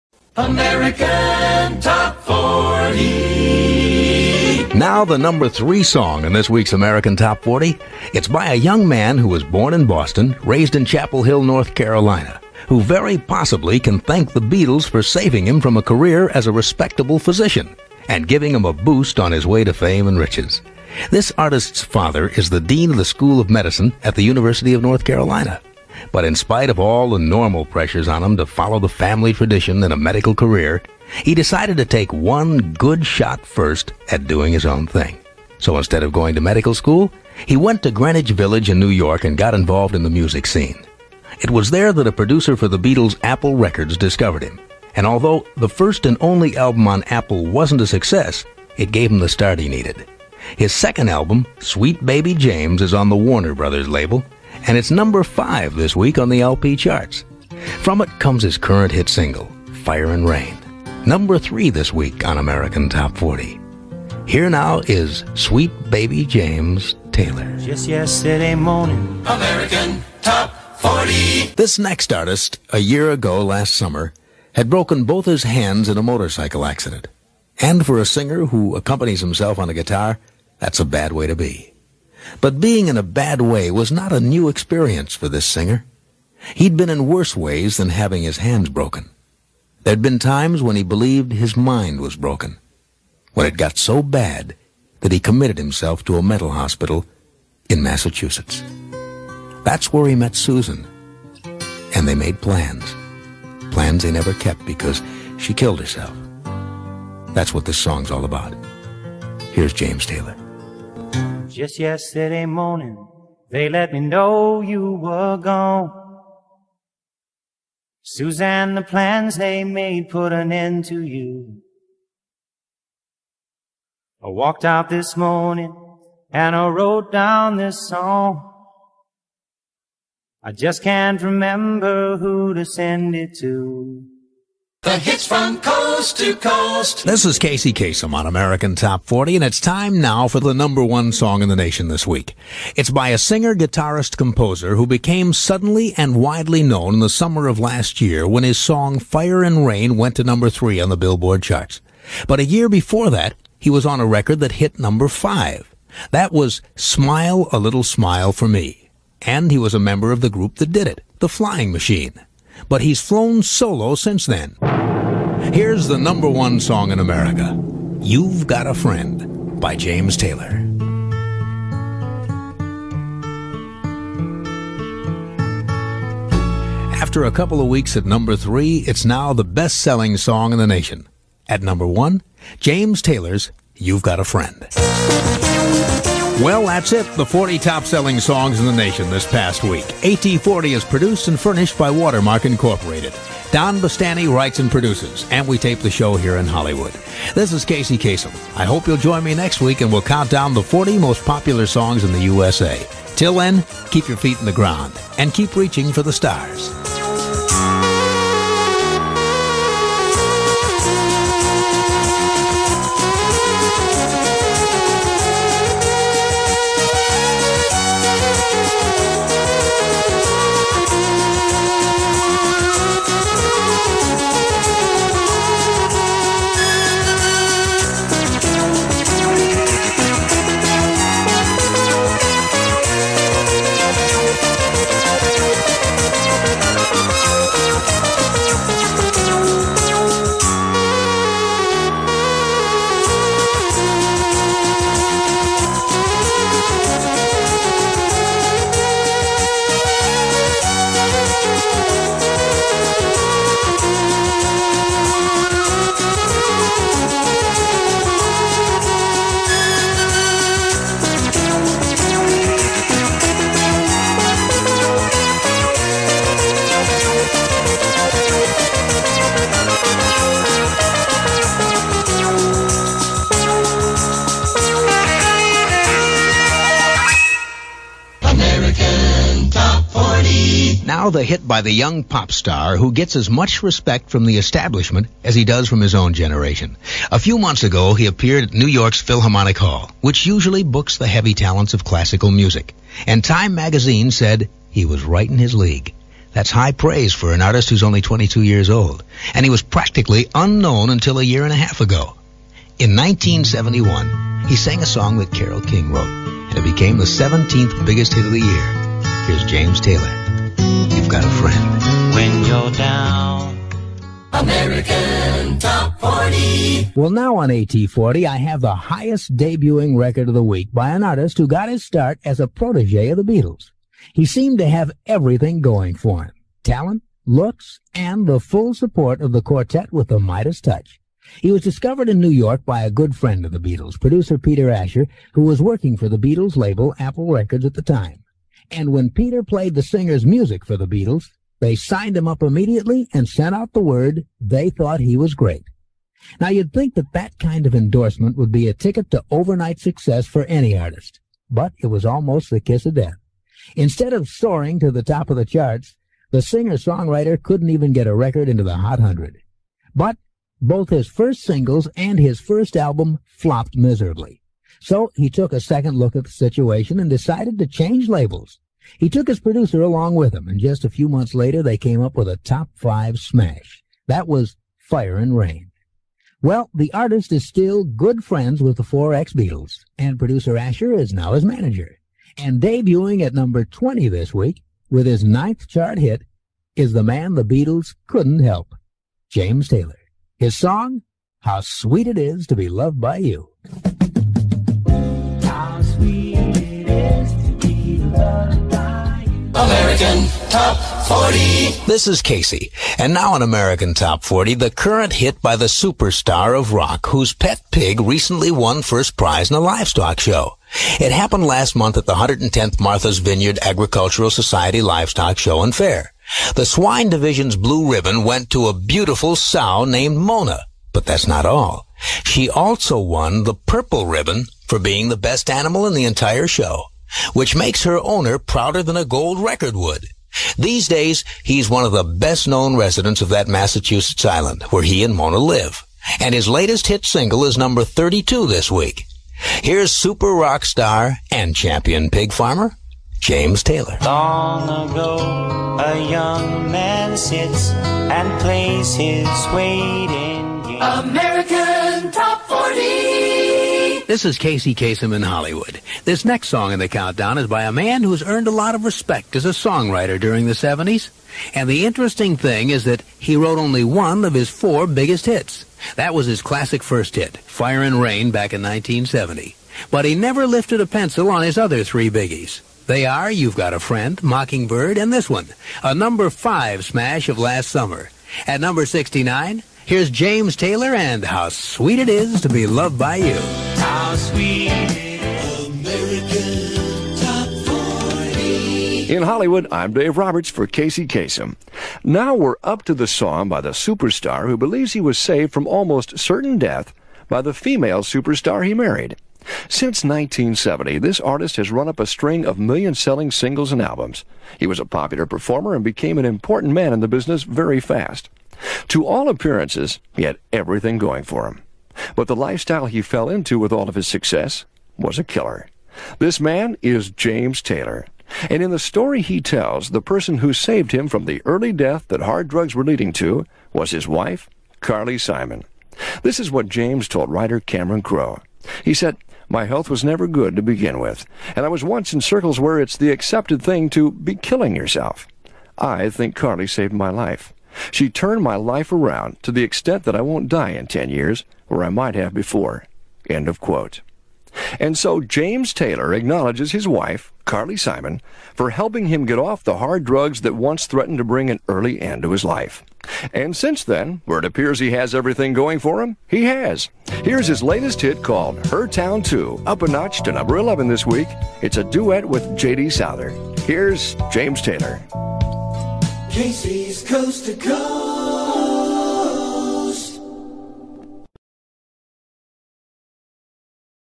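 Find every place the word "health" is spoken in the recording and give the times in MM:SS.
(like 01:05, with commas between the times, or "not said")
08:49.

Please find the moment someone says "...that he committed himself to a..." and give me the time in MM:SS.
01:35.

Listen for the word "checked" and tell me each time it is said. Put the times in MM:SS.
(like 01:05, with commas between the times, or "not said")
not said.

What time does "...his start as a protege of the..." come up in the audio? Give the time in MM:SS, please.
05:21.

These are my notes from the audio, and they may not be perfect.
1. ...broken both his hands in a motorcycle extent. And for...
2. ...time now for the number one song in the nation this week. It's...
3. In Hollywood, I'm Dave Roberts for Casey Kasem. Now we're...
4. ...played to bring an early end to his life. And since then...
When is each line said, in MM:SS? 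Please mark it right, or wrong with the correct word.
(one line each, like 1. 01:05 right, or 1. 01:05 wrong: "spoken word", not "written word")
1. 01:14 wrong: "accident", not "extent"
2. 02:19 right
3. 08:09 right
4. 09:10 wrong: "threatened", not "played".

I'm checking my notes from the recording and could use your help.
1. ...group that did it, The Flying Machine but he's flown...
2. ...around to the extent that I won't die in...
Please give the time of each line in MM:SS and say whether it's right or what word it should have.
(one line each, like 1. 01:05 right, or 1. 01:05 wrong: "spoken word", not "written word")
1. 02:40 right
2. 08:58 right.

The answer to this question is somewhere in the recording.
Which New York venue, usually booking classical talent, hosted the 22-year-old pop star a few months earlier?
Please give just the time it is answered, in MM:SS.
04:49.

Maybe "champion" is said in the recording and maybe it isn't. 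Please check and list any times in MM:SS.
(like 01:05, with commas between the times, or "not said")
07:21.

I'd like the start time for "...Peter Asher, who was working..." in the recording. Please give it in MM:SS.
05:34.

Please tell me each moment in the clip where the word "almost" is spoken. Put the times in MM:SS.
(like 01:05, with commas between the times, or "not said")
05:52, 08:15.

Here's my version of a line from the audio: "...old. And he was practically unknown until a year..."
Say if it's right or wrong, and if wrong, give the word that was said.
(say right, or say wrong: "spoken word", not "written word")
right.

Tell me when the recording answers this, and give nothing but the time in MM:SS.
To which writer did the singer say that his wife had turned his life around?
08:47.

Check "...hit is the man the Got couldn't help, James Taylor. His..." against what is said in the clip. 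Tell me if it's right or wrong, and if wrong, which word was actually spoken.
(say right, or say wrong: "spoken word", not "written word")
wrong: "Beatles", not "Got".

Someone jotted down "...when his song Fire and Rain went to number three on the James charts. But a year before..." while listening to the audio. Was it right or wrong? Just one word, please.
wrong.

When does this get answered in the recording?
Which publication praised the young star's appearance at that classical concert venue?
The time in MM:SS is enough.
04:53.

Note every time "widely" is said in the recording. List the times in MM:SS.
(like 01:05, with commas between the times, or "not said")
02:26.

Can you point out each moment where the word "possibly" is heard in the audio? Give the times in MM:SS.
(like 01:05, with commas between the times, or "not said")
00:13.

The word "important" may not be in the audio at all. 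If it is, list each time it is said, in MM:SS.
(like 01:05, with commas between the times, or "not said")
08:26.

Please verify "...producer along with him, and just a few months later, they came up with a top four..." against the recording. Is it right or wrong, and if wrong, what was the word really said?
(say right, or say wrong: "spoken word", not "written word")
wrong: "five", not "four".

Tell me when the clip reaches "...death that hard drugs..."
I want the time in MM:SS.
08:41.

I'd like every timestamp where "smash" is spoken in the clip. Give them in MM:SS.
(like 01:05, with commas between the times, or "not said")
06:13, 07:56.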